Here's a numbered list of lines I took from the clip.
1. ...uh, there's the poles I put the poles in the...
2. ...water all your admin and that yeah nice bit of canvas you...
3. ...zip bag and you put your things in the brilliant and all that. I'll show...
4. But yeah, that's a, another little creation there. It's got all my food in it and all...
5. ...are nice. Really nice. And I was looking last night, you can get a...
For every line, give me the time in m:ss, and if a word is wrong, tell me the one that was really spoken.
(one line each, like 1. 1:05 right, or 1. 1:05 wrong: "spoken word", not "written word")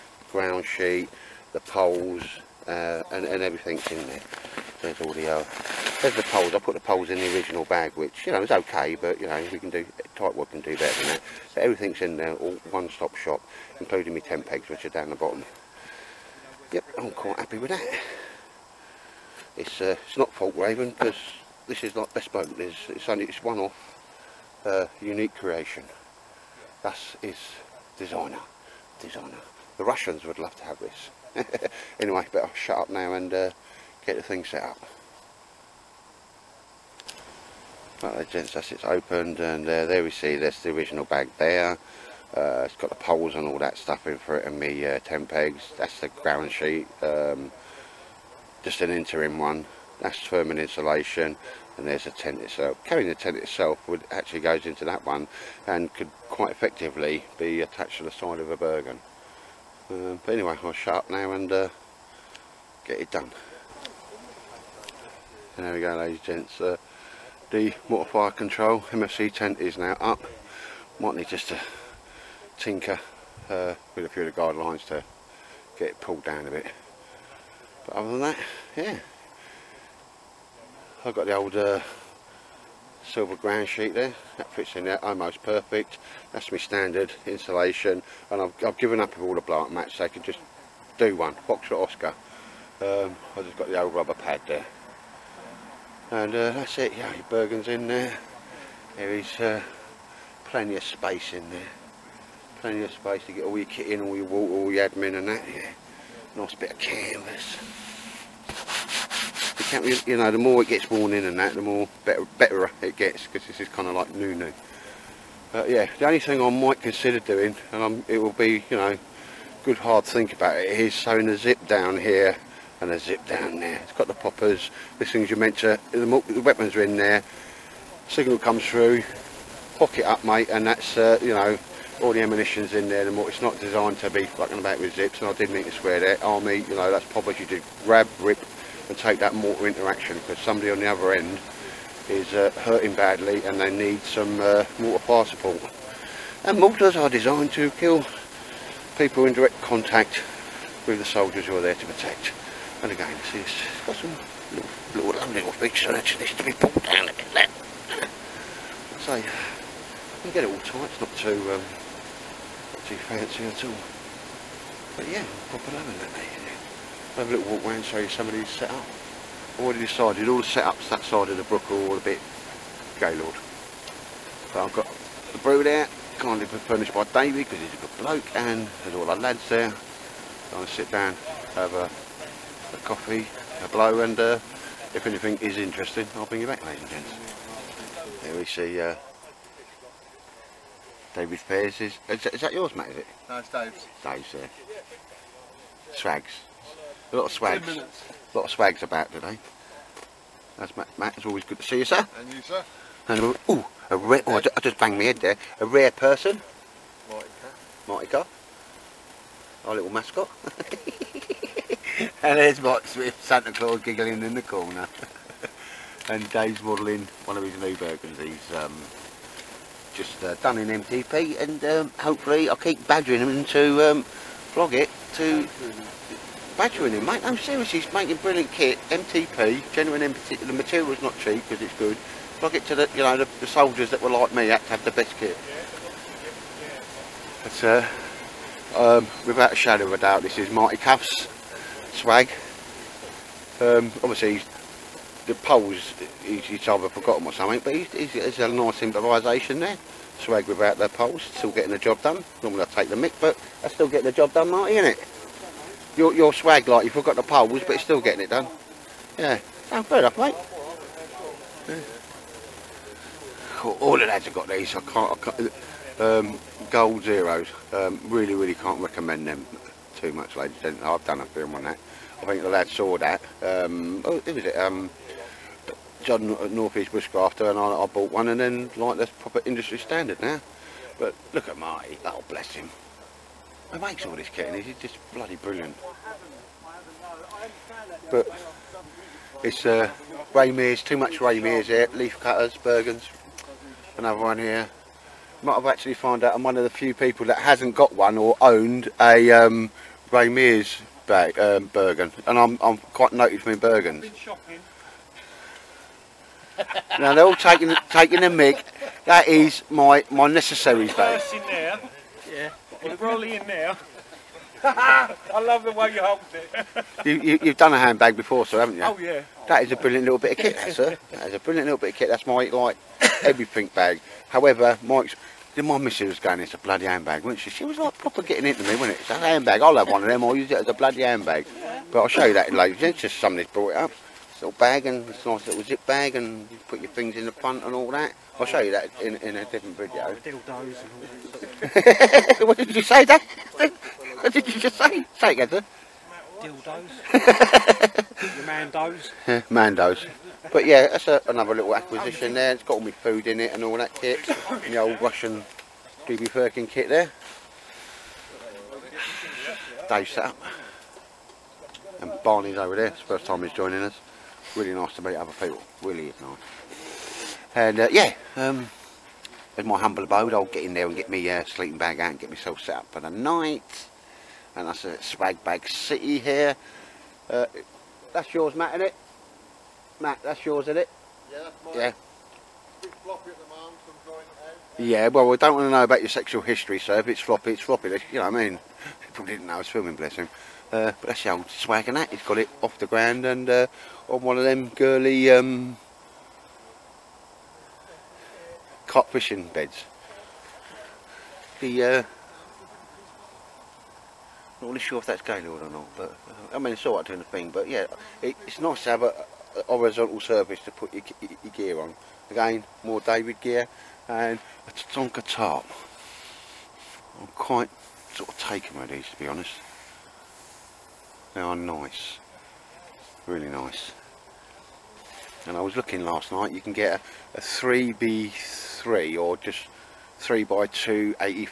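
1. 0:05 right
2. 1:44 right
3. 5:35 wrong: "front", not "brilliant"
4. 5:50 wrong: "acquisition", not "creation"
5. 7:01 right.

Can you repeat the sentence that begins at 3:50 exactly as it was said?
The material's not cheap because it's good.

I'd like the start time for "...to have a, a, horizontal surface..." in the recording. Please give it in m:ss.
6:48.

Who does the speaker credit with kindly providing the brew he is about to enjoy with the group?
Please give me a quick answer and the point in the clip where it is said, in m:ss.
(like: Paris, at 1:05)
Davey, at 2:57.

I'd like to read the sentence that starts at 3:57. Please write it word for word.
But uh, um, without a shadow of a doubt, this is Marty Caff's swag.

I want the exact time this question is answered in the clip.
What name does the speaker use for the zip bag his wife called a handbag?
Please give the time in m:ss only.
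5:10.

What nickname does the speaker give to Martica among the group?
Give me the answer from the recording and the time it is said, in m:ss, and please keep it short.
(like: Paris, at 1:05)
Our little mascot, at 3:29.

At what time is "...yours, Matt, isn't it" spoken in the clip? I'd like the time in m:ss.
6:18.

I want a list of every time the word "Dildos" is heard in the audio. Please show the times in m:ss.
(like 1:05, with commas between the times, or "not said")
5:40, 5:45.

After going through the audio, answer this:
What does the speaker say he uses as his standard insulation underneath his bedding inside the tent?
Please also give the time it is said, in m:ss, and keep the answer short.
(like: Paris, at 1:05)
Silver ground sheet, at 1:23.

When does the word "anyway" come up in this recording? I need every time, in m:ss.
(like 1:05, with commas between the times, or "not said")
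0:31, 1:00.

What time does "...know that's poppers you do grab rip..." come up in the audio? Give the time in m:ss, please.
2:16.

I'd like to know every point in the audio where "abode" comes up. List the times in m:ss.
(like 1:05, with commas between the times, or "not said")
6:10.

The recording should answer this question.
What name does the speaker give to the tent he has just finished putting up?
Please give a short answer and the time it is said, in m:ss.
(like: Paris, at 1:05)
Fire control MFC tent, at 1:08.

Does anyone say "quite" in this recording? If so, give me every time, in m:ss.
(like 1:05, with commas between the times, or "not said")
0:17, 0:56, 5:02, 6:57.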